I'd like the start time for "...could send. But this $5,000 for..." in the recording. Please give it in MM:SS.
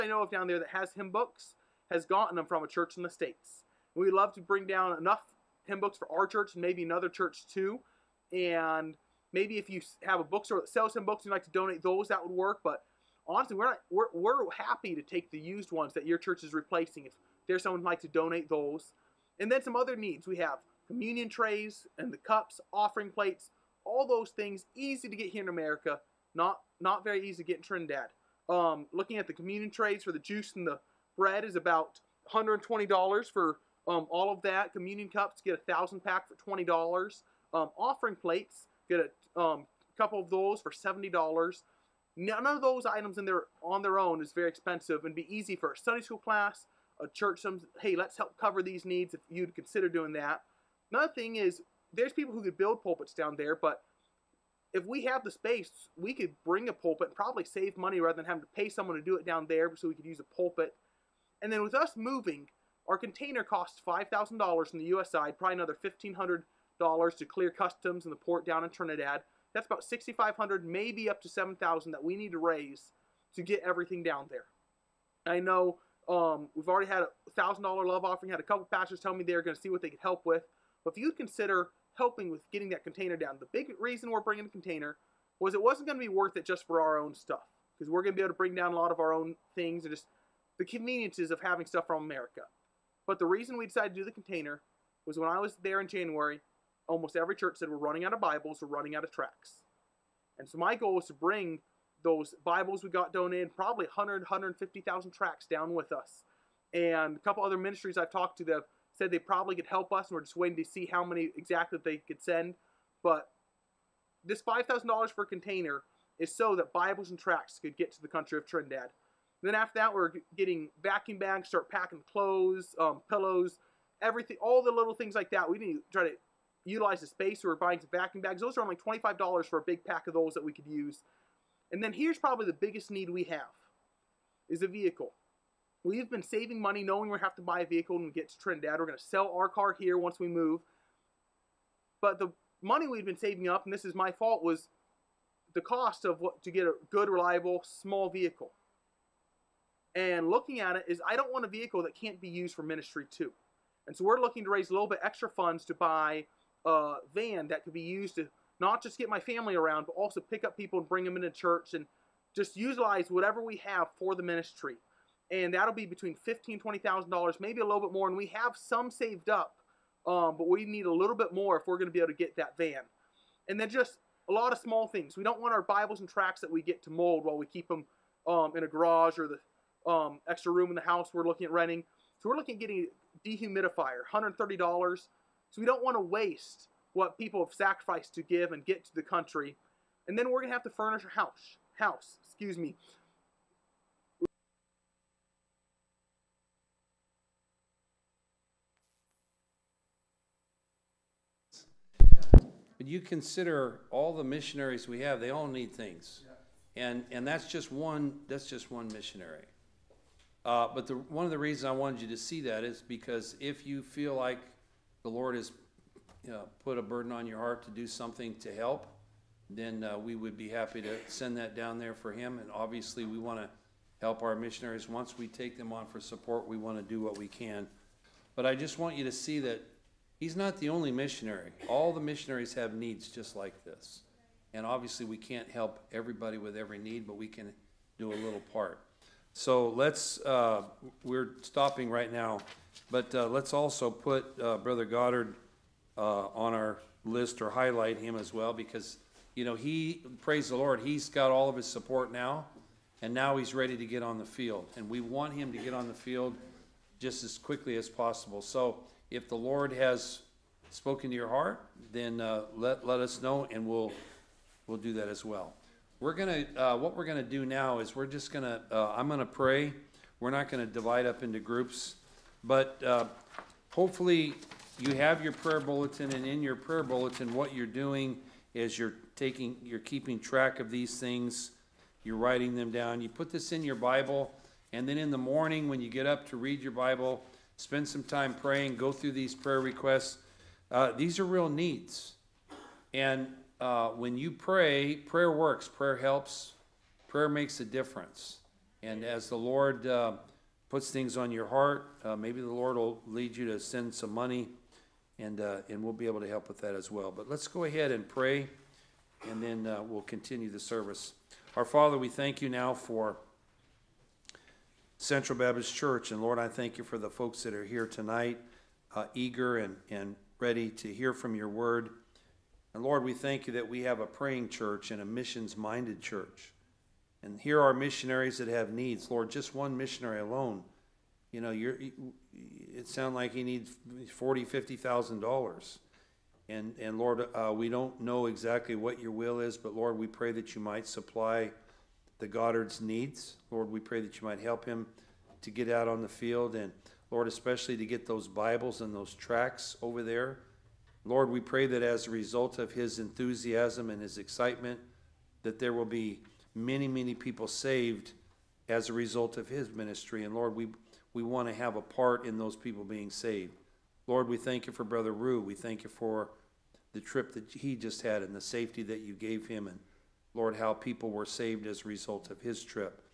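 01:51.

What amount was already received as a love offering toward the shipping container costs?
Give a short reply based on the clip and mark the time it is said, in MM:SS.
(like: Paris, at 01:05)
$1,000, at 01:17.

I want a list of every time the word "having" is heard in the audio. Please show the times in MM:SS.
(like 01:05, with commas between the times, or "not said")
00:58, 01:31.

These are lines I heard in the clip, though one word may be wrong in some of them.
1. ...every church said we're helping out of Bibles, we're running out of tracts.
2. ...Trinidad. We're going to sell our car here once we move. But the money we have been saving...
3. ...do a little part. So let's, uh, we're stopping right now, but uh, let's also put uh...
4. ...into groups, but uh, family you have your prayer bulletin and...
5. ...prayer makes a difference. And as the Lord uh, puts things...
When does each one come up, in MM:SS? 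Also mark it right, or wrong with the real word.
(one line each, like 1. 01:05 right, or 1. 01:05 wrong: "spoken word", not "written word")
1. 01:37 wrong: "running", not "helping"
2. 02:18 right
3. 03:57 right
4. 04:31 wrong: "hopefully", not "family"
5. 04:57 right.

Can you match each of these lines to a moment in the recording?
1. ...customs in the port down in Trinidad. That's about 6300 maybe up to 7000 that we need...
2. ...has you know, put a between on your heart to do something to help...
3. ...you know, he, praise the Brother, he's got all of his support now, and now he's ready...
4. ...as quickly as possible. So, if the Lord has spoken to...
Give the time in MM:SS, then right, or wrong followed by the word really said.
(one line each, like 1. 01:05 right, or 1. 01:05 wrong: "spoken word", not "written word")
1. 01:07 wrong: "6500", not "6300"
2. 03:35 wrong: "burden", not "between"
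3. 04:09 wrong: "Lord", not "Brother"
4. 04:17 right.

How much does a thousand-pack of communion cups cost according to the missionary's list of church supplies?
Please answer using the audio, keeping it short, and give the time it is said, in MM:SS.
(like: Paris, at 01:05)
$20, at 00:36.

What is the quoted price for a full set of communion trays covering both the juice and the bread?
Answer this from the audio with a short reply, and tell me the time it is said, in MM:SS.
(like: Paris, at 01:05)
$120, at 00:32.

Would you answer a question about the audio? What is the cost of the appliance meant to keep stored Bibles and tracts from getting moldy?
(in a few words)
$130.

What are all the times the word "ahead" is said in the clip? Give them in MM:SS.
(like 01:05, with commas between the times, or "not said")
05:07.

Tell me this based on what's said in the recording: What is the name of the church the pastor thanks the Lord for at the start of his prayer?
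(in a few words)
Central Baptist Church.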